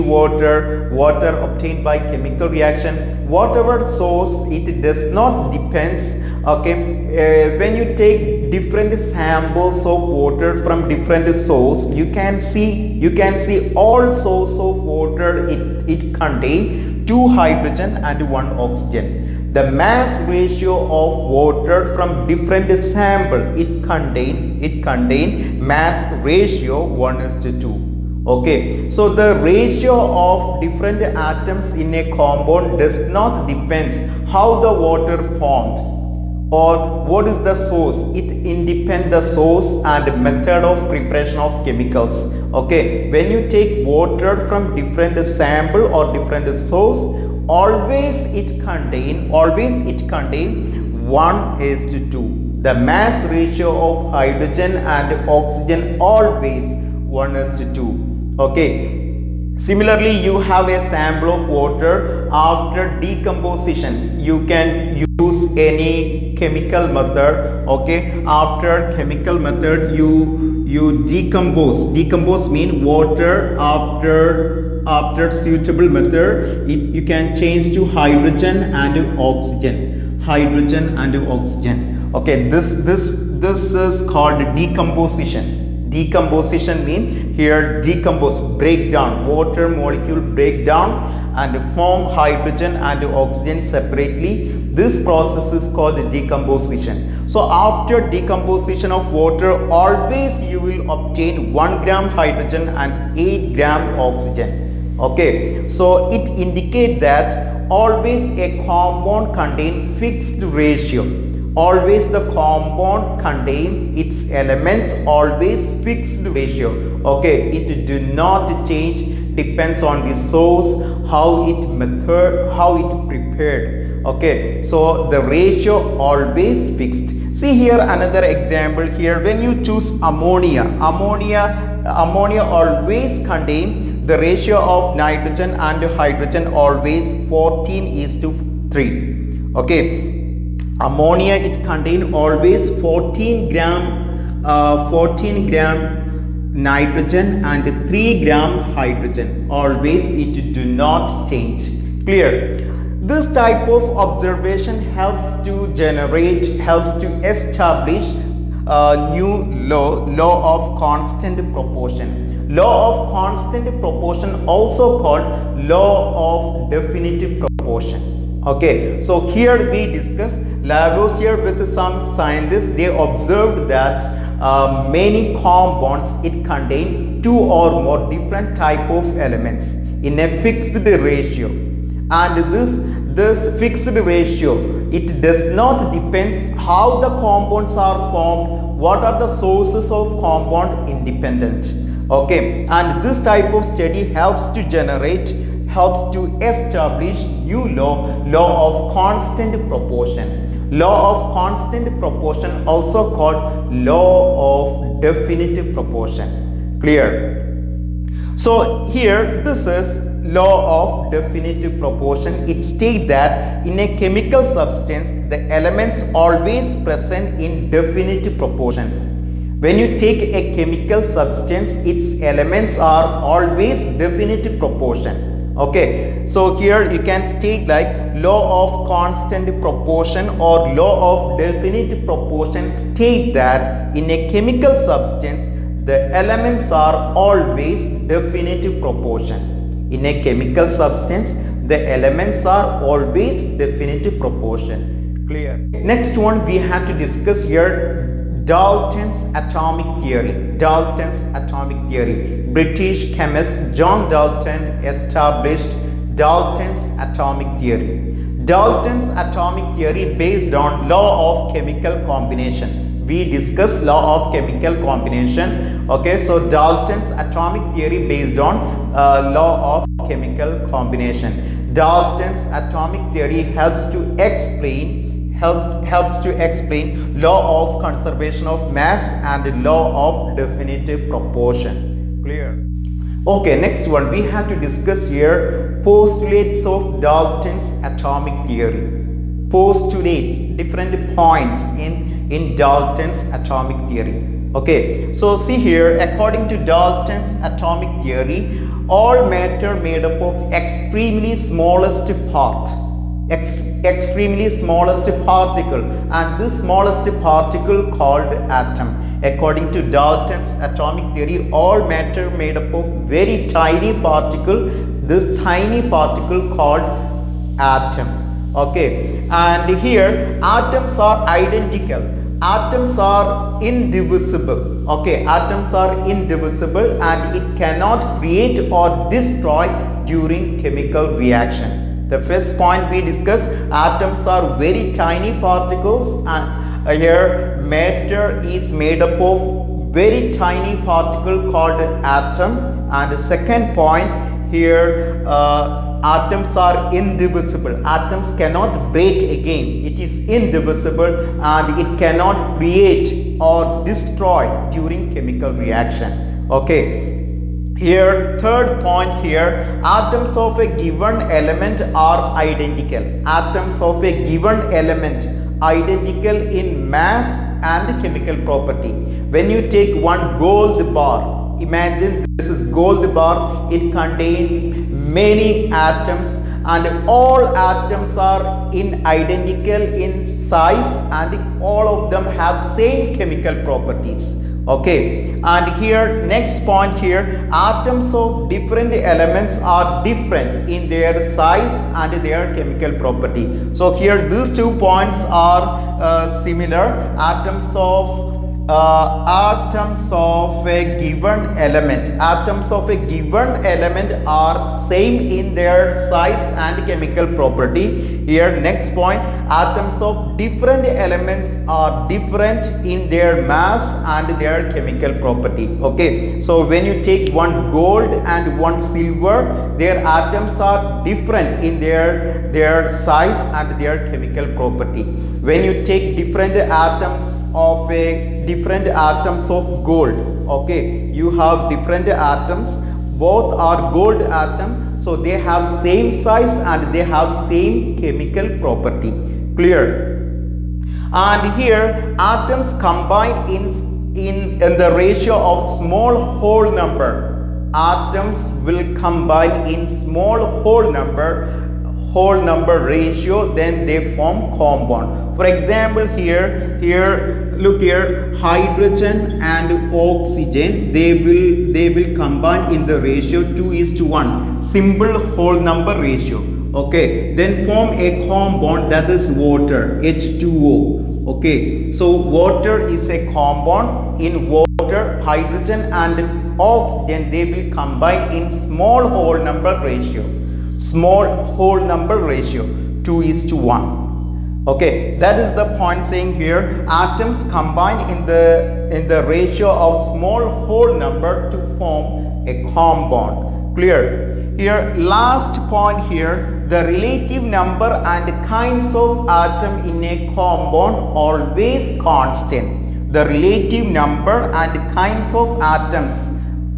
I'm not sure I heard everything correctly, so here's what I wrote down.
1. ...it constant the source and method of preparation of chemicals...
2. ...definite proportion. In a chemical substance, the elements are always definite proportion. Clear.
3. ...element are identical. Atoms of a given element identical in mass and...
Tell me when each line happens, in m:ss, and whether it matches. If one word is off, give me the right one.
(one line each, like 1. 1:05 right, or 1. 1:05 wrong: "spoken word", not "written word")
1. 0:38 wrong: "independent", not "constant"
2. 3:58 right
3. 6:01 right.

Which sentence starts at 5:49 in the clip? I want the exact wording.
It is indivisible and it cannot create or destroy during chemical reaction.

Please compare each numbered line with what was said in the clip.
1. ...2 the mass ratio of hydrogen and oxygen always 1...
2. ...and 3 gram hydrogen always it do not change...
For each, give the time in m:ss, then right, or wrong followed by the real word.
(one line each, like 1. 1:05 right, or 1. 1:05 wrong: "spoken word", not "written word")
1. 0:52 right
2. 2:27 right.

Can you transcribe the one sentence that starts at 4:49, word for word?
Postulates, different points in, in Dalton's atomic theory.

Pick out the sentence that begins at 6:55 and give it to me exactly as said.
Okay, so when you take one gold and one silver, their atoms are different in their, their size and their chemical property.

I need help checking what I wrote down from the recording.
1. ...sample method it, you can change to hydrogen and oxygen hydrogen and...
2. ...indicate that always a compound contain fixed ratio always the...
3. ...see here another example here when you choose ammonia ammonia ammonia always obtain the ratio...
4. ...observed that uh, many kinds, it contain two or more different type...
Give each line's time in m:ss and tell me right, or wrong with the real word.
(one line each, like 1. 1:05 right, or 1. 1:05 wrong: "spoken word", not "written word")
1. 1:15 wrong: "suitable", not "sample"
2. 1:46 right
3. 2:07 wrong: "contain", not "obtain"
4. 2:52 wrong: "compounds", not "kinds".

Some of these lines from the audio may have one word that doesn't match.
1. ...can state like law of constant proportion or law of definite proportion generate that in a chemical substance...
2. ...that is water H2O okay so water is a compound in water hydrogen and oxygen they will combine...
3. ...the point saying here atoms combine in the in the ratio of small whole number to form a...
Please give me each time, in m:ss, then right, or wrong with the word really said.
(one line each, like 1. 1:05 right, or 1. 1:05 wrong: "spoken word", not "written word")
1. 3:47 wrong: "state", not "generate"
2. 7:48 right
3. 8:05 right.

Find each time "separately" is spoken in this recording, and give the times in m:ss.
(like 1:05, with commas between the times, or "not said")
1:33.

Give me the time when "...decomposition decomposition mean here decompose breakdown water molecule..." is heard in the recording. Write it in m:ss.
1:24.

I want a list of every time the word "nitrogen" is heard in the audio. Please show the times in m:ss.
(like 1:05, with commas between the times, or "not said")
2:14, 2:26.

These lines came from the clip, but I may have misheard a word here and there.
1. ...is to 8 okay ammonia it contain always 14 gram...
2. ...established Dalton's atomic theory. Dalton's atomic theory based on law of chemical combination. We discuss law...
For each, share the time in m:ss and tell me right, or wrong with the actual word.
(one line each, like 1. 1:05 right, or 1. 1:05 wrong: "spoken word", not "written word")
1. 2:18 wrong: "3", not "8"
2. 4:14 right.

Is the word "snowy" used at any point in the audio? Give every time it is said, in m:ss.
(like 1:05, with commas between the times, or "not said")
not said.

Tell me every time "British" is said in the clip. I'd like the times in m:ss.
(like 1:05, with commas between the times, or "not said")
4:12.